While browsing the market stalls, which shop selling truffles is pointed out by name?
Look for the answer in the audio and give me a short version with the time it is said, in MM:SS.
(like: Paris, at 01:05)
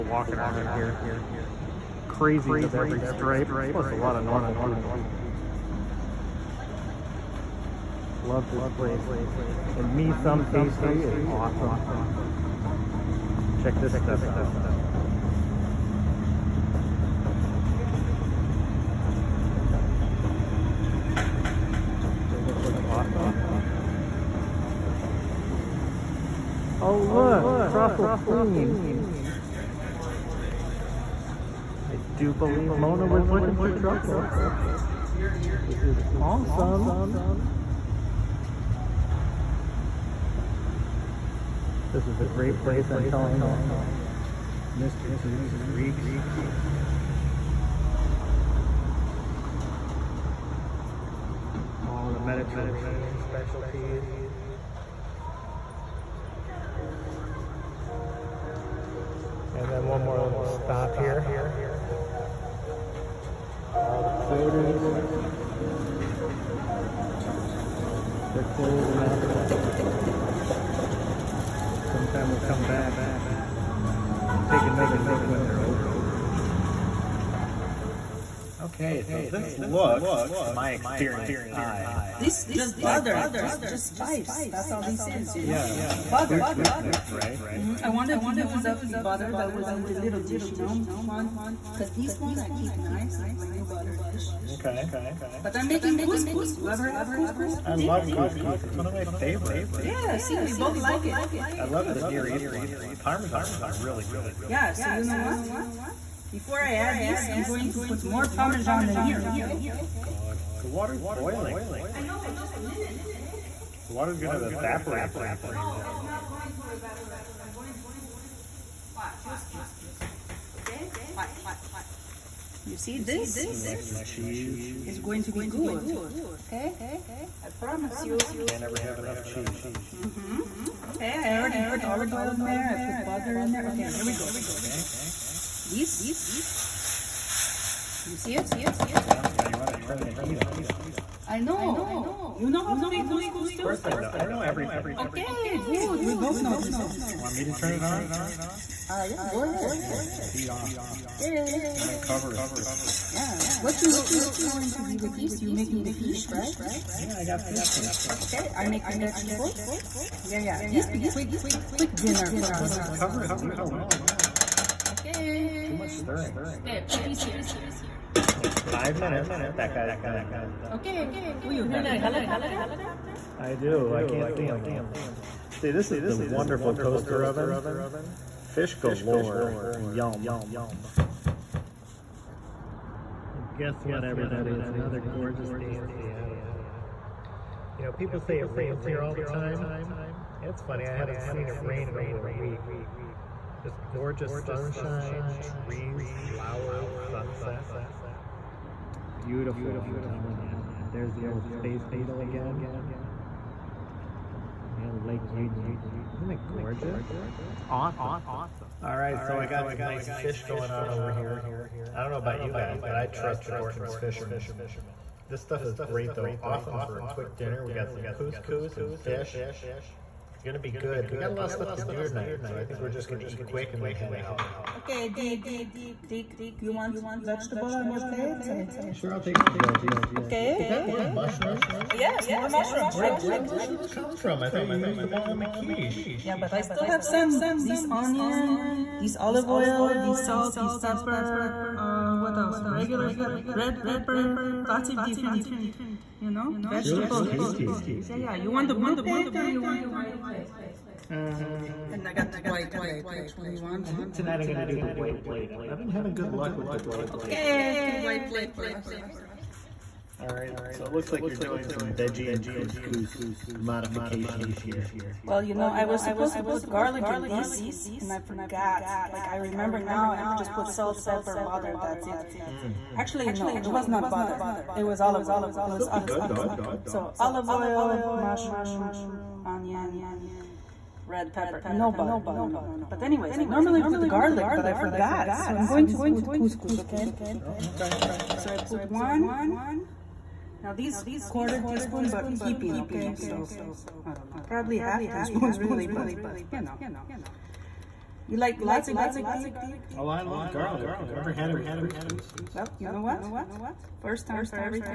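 Truffle Queen, at 00:27.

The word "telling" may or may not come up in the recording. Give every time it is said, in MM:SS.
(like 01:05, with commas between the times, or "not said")
00:43, 03:20.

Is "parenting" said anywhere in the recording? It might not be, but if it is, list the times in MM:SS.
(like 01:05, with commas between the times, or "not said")
not said.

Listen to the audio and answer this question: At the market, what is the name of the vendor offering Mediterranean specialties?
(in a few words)
Mr. D's Greeks.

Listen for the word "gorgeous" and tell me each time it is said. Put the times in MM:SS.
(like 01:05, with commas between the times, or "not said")
03:05, 03:13, 03:26.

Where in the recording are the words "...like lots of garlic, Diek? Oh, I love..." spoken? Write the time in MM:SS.
04:58.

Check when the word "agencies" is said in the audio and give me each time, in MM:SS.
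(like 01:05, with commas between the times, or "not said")
not said.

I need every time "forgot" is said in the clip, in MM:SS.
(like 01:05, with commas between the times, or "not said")
04:28, 04:44.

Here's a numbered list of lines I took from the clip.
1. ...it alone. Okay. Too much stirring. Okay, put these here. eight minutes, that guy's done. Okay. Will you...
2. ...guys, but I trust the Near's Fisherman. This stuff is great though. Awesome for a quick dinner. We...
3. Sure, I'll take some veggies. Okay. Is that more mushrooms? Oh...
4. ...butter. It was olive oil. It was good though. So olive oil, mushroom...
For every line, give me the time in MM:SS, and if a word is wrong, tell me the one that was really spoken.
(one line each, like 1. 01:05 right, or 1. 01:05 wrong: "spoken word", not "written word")
1. 02:43 wrong: "five", not "eight"
2. 03:32 wrong: "Gorton", not "Near"
3. 03:48 right
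4. 04:34 right.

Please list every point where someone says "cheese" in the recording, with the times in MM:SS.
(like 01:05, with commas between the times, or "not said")
02:03, 02:09.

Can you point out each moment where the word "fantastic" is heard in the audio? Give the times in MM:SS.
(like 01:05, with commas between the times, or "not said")
not said.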